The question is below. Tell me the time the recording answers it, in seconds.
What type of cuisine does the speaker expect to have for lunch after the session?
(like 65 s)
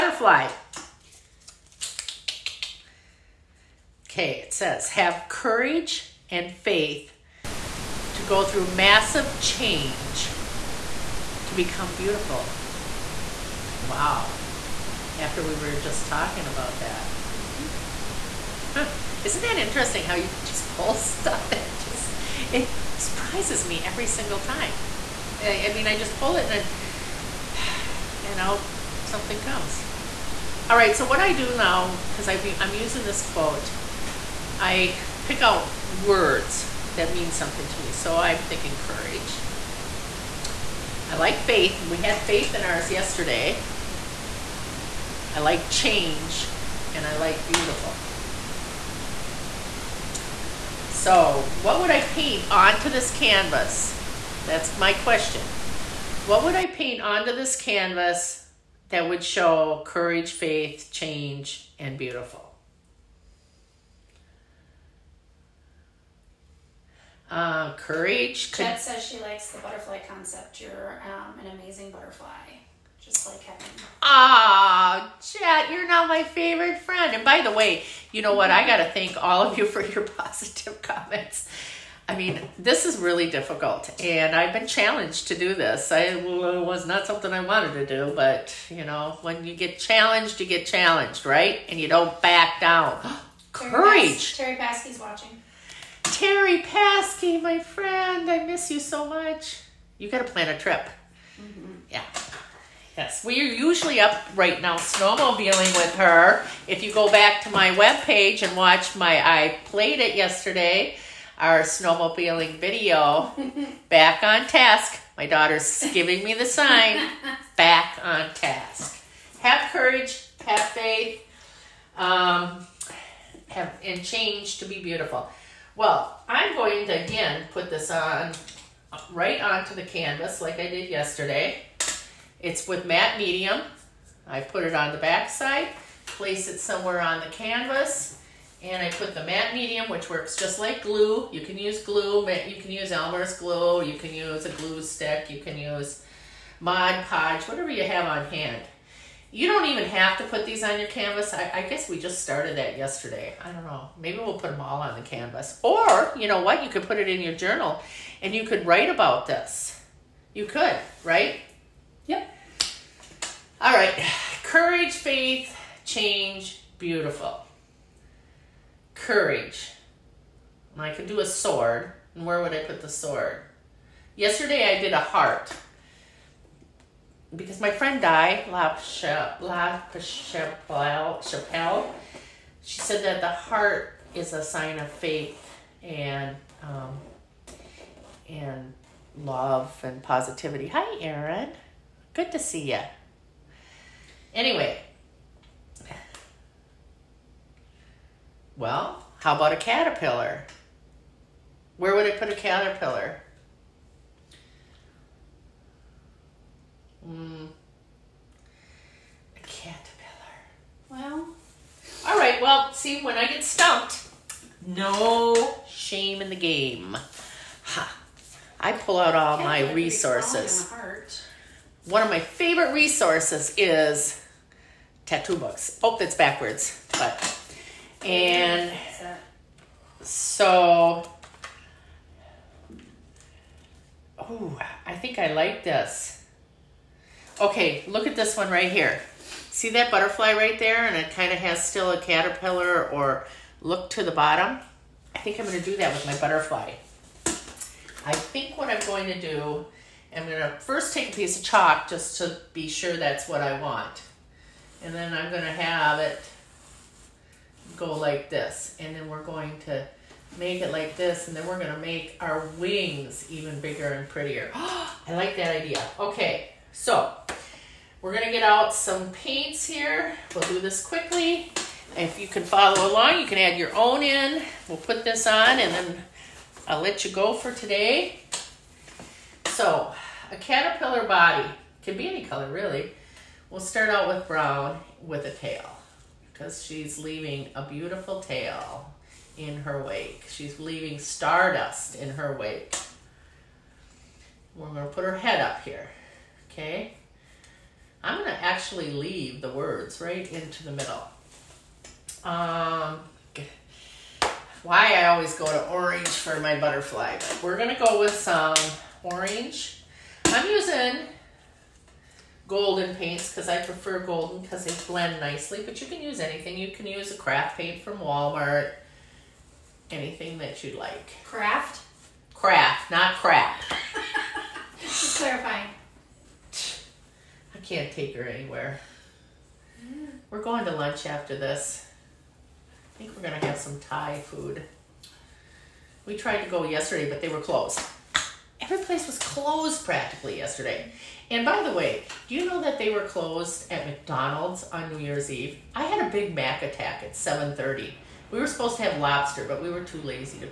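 333 s.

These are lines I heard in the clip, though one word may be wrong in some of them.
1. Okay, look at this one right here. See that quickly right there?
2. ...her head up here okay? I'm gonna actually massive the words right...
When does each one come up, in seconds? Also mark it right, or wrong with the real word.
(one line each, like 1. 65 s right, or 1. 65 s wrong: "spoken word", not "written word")
1. 237 s wrong: "butterfly", not "quickly"
2. 295 s wrong: "leave", not "massive".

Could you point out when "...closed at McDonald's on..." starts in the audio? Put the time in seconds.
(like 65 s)
343 s.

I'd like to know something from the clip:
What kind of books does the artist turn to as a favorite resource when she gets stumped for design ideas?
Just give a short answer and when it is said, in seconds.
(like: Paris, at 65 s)
Tattoo books, at 225 s.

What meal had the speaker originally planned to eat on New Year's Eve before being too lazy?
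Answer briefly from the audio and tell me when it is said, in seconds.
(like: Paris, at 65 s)
Lobster, at 349 s.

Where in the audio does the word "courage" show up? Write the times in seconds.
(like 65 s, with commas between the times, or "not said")
5 s, 38 s, 59 s, 67 s, 93 s, 119 s, 164 s, 168 s.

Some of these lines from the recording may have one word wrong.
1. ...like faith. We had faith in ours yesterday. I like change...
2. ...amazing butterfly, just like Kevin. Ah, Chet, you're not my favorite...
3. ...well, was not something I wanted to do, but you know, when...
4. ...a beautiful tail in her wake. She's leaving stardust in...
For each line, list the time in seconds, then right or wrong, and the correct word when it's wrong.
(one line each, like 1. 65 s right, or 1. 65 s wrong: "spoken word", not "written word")
1. 41 s right
2. 71 s right
3. 86 s right
4. 287 s right.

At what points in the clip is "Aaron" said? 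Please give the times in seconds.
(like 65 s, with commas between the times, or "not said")
191 s.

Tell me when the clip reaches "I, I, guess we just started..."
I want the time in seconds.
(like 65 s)
151 s.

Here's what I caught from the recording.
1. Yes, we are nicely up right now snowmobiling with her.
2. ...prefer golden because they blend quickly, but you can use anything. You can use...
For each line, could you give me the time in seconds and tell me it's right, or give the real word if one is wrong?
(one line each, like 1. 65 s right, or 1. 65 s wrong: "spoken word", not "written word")
1. 102 s wrong: "usually", not "nicely"
2. 313 s wrong: "nicely", not "quickly".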